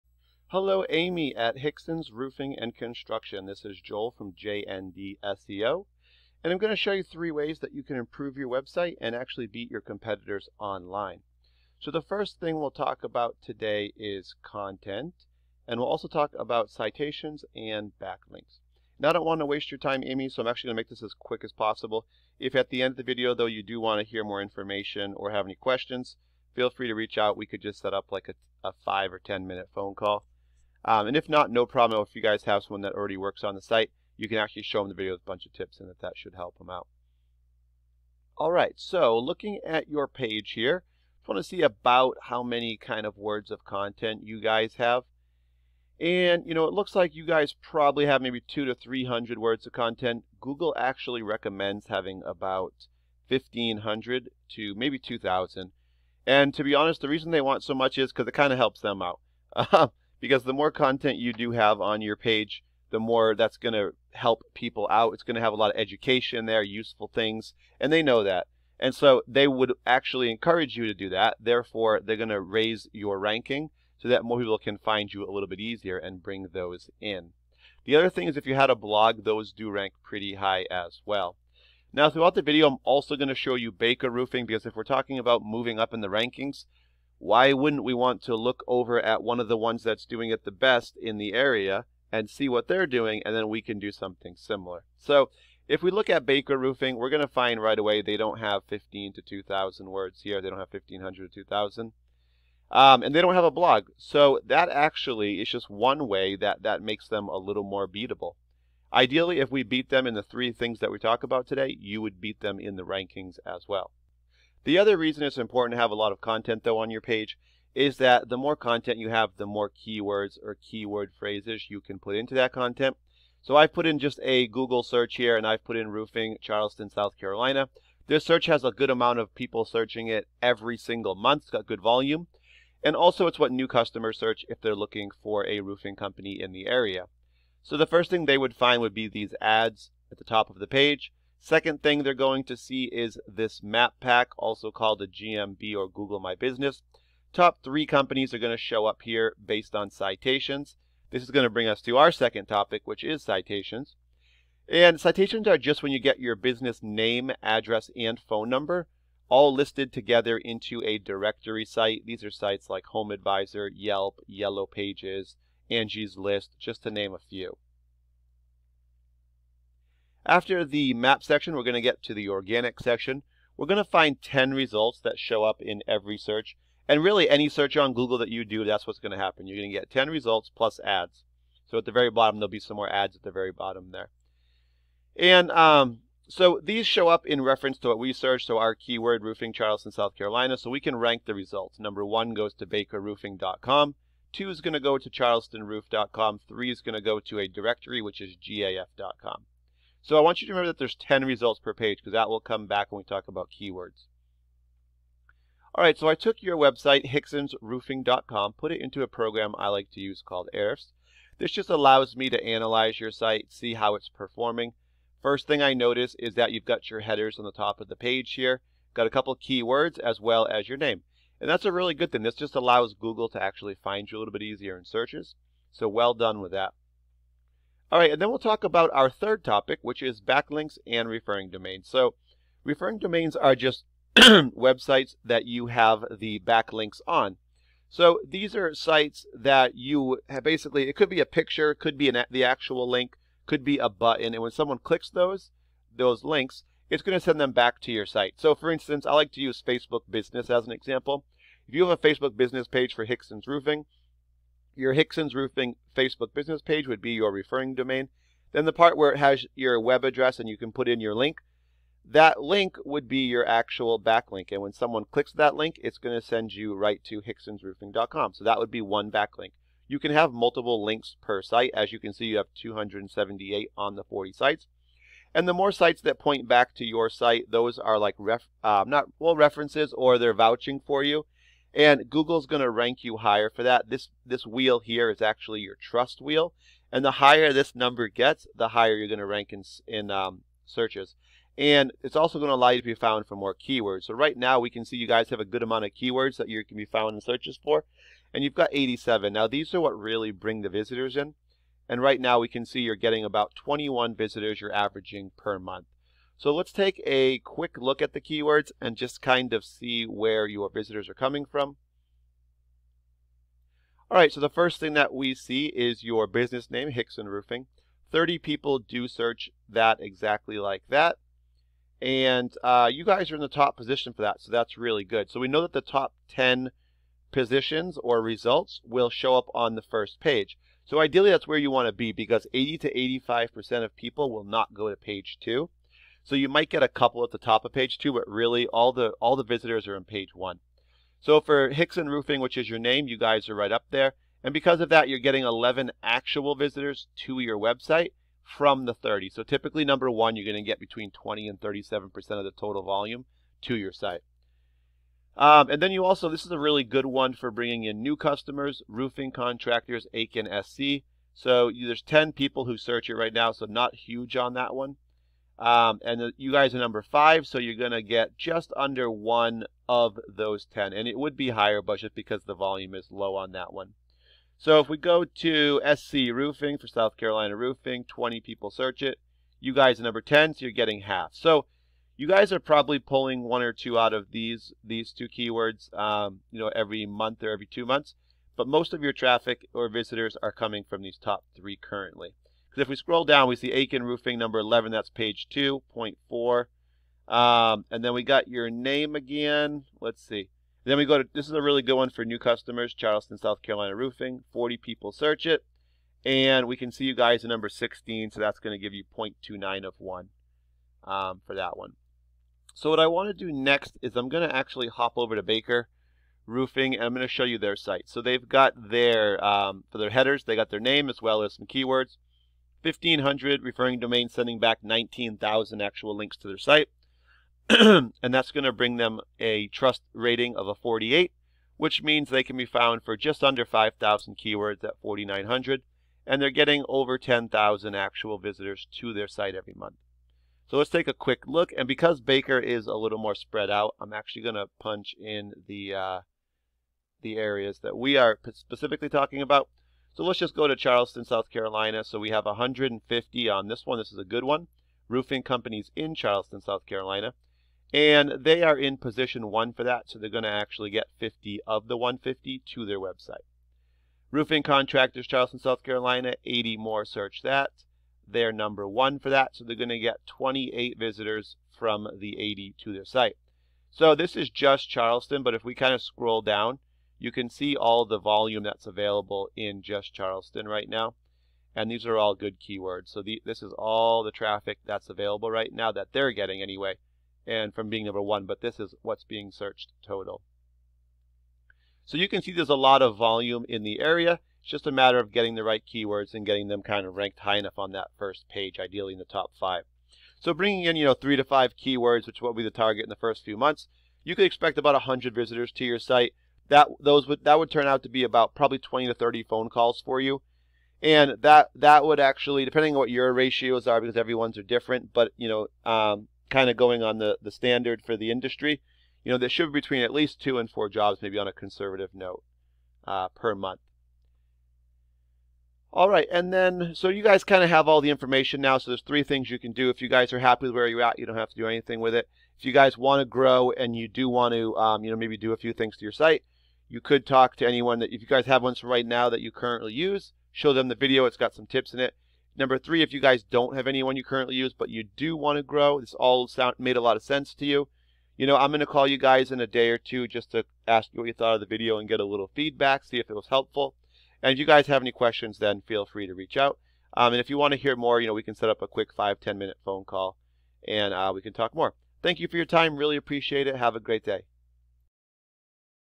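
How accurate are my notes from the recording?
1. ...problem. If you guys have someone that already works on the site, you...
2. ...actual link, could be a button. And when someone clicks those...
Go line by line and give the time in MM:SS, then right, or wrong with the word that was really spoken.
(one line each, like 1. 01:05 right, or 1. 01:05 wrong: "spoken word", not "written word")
1. 00:31 right
2. 04:02 right.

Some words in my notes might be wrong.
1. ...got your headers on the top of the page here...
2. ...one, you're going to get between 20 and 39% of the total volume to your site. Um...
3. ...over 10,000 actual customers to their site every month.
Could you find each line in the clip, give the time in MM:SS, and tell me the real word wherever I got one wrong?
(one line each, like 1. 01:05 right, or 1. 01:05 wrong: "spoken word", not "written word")
1. 03:36 right
2. 05:50 wrong: "37", not "39"
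3. 07:16 wrong: "visitors", not "customers".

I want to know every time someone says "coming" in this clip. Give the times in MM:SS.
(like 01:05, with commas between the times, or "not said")
05:11, 06:30.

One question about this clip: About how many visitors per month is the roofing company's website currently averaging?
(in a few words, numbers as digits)
21.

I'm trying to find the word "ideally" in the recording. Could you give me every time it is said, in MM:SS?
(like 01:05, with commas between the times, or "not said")
01:48, 05:30, 08:18.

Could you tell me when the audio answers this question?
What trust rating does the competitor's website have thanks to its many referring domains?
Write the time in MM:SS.
07:10.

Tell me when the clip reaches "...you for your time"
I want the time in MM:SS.
09:22.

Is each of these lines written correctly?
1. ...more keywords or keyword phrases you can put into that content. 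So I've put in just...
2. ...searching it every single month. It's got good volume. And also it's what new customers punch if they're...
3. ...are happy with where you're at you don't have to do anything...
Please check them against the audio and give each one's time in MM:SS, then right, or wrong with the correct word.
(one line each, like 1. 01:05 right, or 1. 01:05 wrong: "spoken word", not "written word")
1. 01:59 right
2. 02:09 wrong: "search", not "punch"
3. 08:50 right.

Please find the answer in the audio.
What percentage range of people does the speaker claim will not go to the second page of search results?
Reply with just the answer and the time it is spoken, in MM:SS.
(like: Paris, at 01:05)
80 to 85%, at 05:32.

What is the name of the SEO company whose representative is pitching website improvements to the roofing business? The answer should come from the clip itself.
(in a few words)
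JND SEO.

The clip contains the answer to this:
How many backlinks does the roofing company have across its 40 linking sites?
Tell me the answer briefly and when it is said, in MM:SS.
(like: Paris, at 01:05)
278, at 04:32.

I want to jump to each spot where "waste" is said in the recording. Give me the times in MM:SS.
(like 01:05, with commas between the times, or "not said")
00:19.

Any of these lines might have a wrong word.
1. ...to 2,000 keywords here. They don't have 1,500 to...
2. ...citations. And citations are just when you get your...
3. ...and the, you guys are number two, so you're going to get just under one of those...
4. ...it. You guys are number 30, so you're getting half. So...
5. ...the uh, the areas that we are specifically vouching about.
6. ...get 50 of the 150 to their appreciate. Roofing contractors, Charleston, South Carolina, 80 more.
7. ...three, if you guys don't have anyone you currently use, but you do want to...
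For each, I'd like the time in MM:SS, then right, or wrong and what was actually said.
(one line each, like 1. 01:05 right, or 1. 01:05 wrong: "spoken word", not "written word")
1. 01:39 wrong: "words", not "keywords"
2. 02:33 right
3. 06:06 wrong: "five", not "two"
4. 06:19 wrong: "10", not "30"
5. 07:25 wrong: "talking", not "vouching"
6. 07:40 wrong: "website", not "appreciate"
7. 09:02 right.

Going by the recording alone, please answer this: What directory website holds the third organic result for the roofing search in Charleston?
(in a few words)
gaf.com.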